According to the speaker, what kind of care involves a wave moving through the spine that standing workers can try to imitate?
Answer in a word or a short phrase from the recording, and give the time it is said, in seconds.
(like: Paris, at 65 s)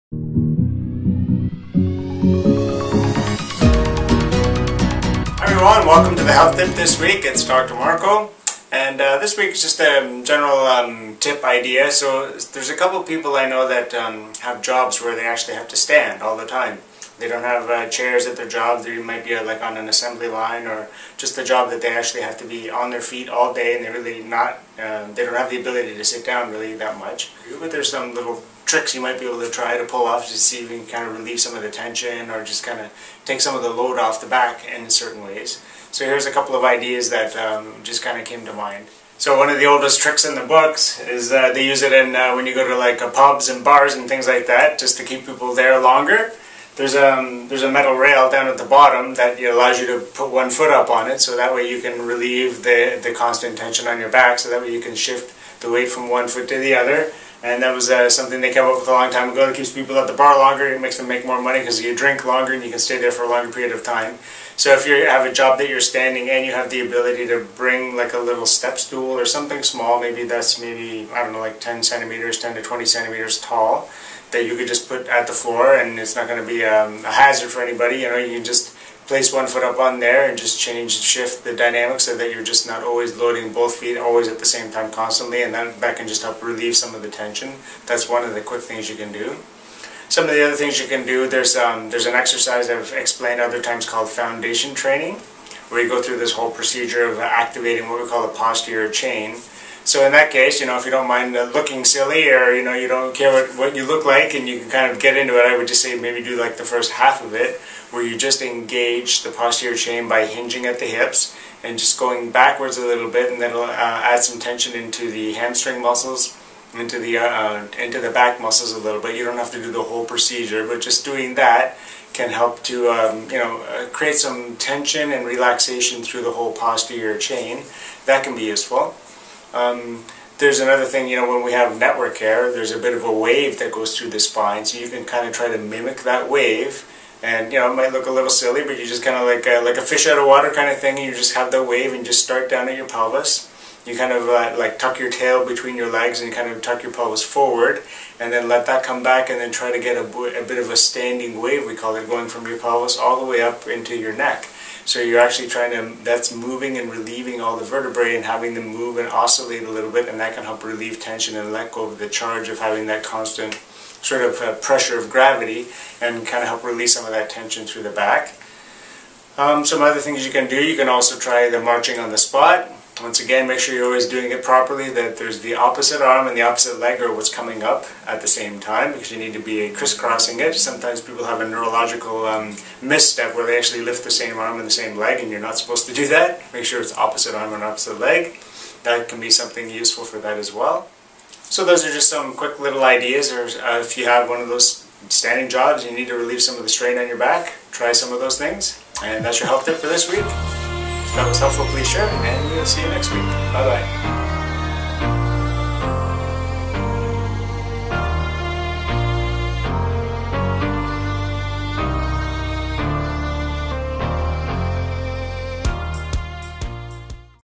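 network care, at 131 s.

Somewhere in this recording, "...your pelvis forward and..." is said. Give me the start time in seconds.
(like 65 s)
146 s.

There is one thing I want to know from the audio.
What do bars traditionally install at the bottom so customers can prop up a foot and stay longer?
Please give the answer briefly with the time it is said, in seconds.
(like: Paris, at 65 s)
metal rail, at 47 s.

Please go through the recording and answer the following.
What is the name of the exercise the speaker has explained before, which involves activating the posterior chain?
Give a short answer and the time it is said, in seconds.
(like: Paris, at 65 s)
foundation training, at 94 s.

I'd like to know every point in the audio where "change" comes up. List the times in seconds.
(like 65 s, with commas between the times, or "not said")
80 s.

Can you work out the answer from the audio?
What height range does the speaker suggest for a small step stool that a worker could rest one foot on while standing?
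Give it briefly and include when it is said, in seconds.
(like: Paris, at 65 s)
10 to 20 centimeters, at 72 s.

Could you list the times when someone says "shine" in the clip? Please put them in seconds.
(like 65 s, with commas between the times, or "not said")
not said.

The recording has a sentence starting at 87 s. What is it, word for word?
That's one of the quick things you can do.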